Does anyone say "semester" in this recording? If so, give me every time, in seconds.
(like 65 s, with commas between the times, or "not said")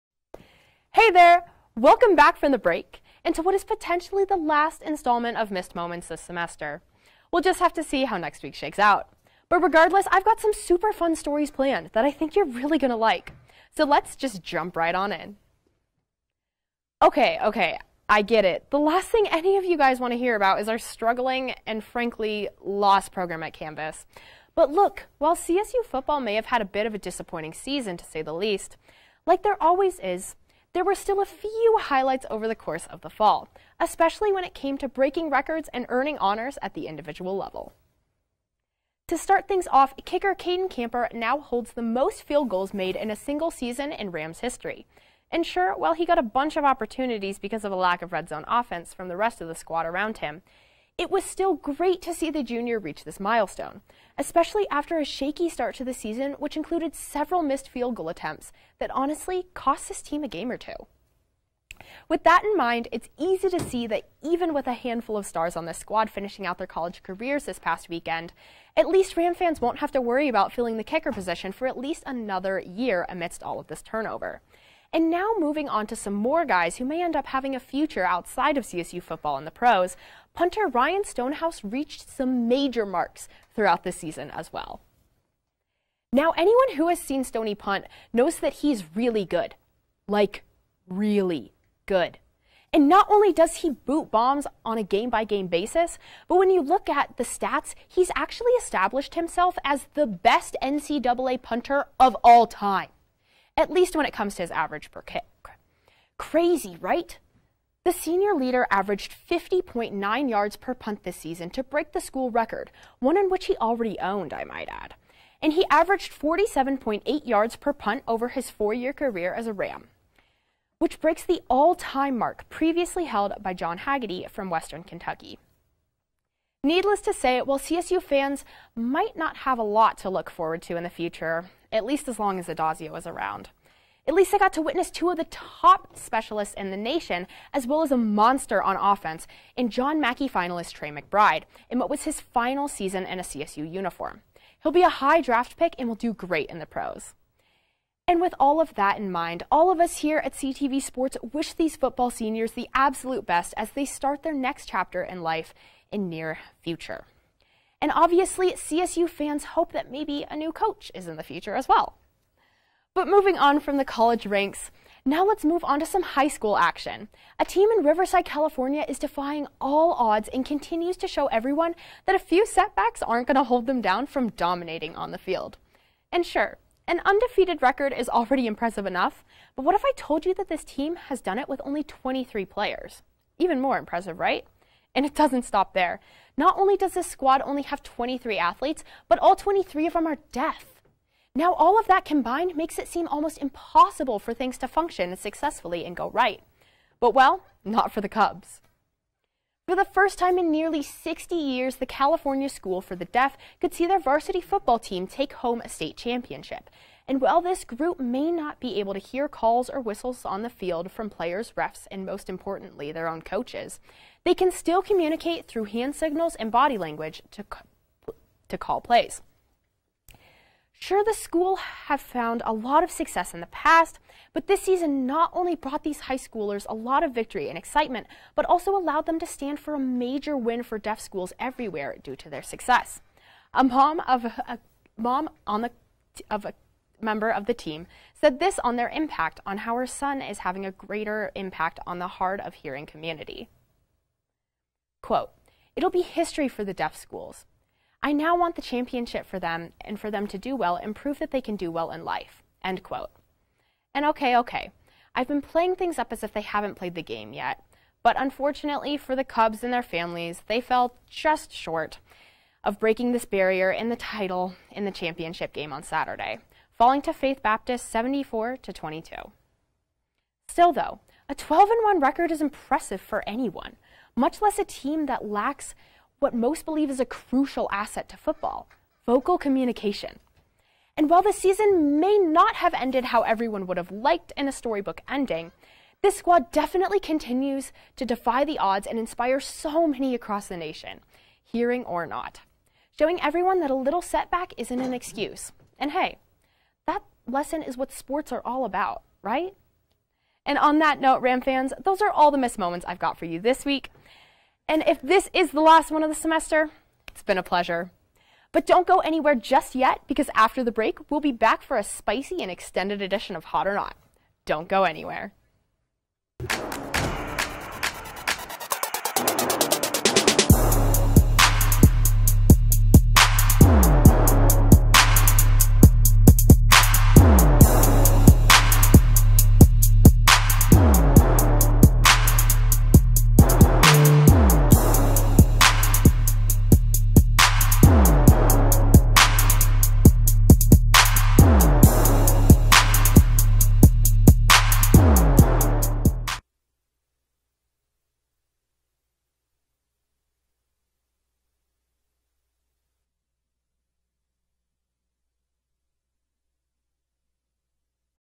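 6 s, 306 s.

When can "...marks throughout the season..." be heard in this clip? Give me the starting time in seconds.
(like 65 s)
82 s.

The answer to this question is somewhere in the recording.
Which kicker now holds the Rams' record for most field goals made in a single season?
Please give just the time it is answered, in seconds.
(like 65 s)
40 s.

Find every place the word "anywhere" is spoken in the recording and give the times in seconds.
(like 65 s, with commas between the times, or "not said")
308 s, 314 s.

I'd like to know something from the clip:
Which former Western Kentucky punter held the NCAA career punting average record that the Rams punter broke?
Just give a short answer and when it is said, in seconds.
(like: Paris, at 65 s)
John Haggerty, at 123 s.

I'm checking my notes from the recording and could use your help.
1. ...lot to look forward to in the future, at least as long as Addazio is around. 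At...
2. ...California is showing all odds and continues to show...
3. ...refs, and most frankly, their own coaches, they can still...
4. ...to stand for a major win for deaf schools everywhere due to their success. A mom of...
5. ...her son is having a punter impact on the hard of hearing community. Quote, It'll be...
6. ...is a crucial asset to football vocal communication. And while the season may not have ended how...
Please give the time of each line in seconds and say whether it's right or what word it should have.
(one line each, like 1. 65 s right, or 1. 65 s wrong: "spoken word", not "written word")
1. 129 s right
2. 168 s wrong: "defying", not "showing"
3. 211 s wrong: "importantly", not "frankly"
4. 229 s right
5. 239 s wrong: "greater", not "punter"
6. 276 s right.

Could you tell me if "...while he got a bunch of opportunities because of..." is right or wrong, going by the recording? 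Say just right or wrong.
right.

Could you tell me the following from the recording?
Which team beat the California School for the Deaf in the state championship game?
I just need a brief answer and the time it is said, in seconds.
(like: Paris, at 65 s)
Faith Baptist, at 267 s.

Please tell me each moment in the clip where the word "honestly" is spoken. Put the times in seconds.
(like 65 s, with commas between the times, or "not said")
58 s.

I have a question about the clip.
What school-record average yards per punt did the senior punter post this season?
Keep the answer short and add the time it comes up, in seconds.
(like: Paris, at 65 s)
50.9, at 109 s.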